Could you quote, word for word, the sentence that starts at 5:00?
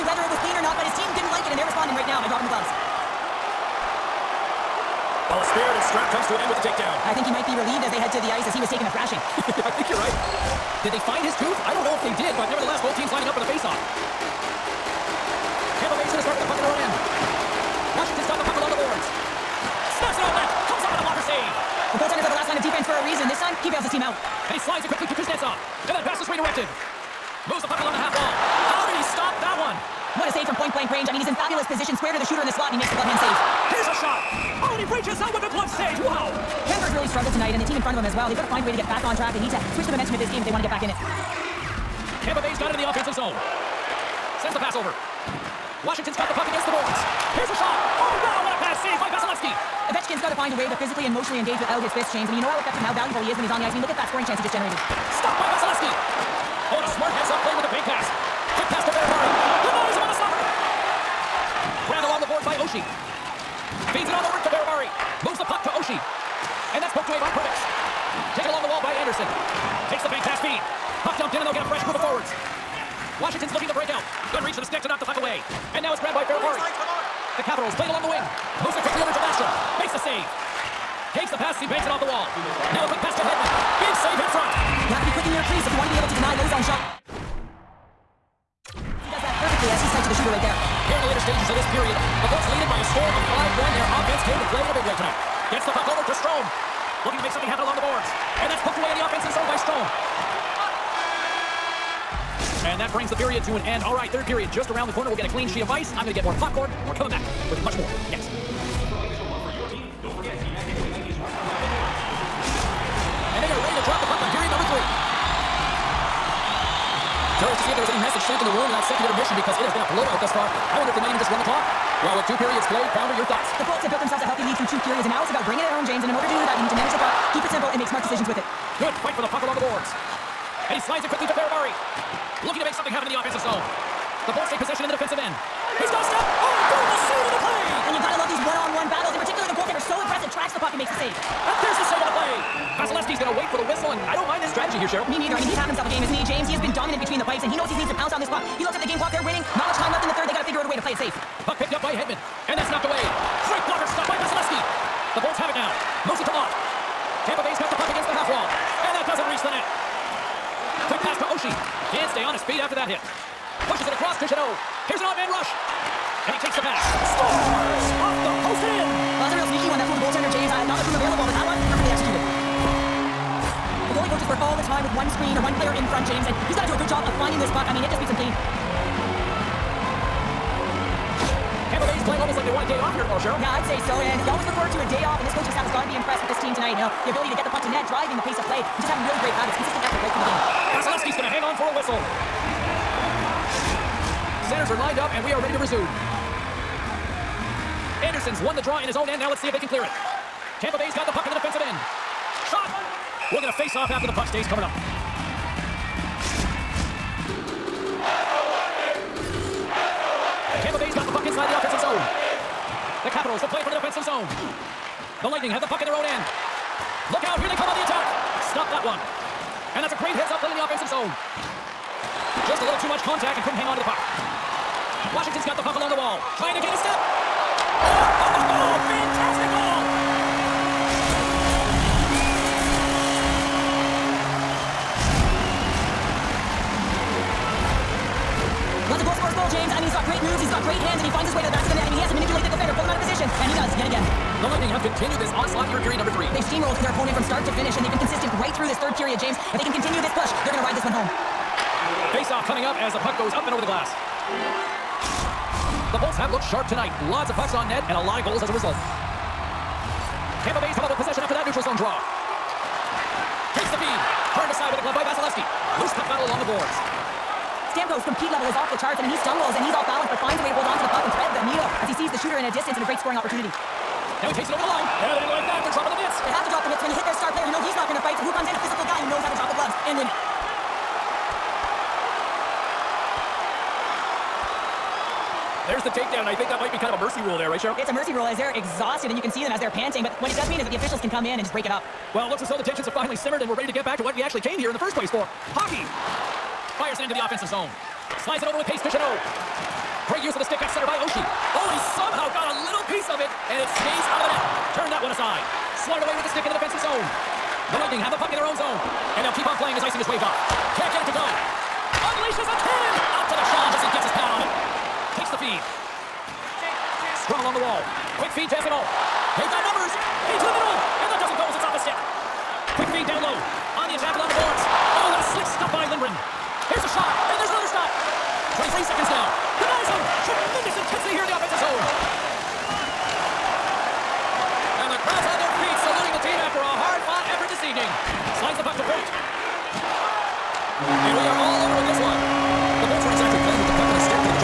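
Great use of the stick at center by Oshie.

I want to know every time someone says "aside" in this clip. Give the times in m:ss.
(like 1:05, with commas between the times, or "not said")
4:24, 5:05.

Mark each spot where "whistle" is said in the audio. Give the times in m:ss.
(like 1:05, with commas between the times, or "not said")
2:23, 3:11.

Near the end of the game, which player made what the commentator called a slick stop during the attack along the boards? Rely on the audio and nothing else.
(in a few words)
Lindgren.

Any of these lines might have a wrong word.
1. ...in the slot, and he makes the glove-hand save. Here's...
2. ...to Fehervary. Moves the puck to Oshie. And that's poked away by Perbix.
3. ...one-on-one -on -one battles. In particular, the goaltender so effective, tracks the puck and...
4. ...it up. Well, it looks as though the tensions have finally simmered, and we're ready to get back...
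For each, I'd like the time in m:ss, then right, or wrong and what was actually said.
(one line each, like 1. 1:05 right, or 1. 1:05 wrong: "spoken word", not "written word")
1. 0:32 right
2. 1:04 right
3. 2:18 wrong: "impressive", not "effective"
4. 4:51 right.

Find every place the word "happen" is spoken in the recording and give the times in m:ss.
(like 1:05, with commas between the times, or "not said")
1:37, 2:12.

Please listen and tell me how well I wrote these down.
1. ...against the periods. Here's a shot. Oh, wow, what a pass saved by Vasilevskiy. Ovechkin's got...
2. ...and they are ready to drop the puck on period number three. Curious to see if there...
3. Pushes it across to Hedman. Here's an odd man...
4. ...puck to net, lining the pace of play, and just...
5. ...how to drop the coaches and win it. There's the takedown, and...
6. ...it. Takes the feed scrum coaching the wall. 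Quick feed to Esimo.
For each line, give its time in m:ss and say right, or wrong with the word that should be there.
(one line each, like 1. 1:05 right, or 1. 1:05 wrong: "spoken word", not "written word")
1. 0:46 wrong: "boards", not "periods"
2. 1:53 right
3. 2:43 wrong: "Jeannot", not "Hedman"
4. 3:07 wrong: "driving", not "lining"
5. 4:39 wrong: "gloves", not "coaches"
6. 5:14 wrong: "along", not "coaching".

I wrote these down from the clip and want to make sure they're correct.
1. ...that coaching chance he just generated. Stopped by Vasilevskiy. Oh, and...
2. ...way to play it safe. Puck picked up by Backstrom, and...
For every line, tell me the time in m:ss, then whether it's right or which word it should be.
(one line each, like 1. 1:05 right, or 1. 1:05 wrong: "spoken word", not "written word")
1. 0:53 wrong: "scoring", not "coaching"
2. 2:30 wrong: "Hedman", not "Backstrom".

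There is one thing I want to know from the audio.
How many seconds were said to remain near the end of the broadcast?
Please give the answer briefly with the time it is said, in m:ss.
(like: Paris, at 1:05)
23, at 5:28.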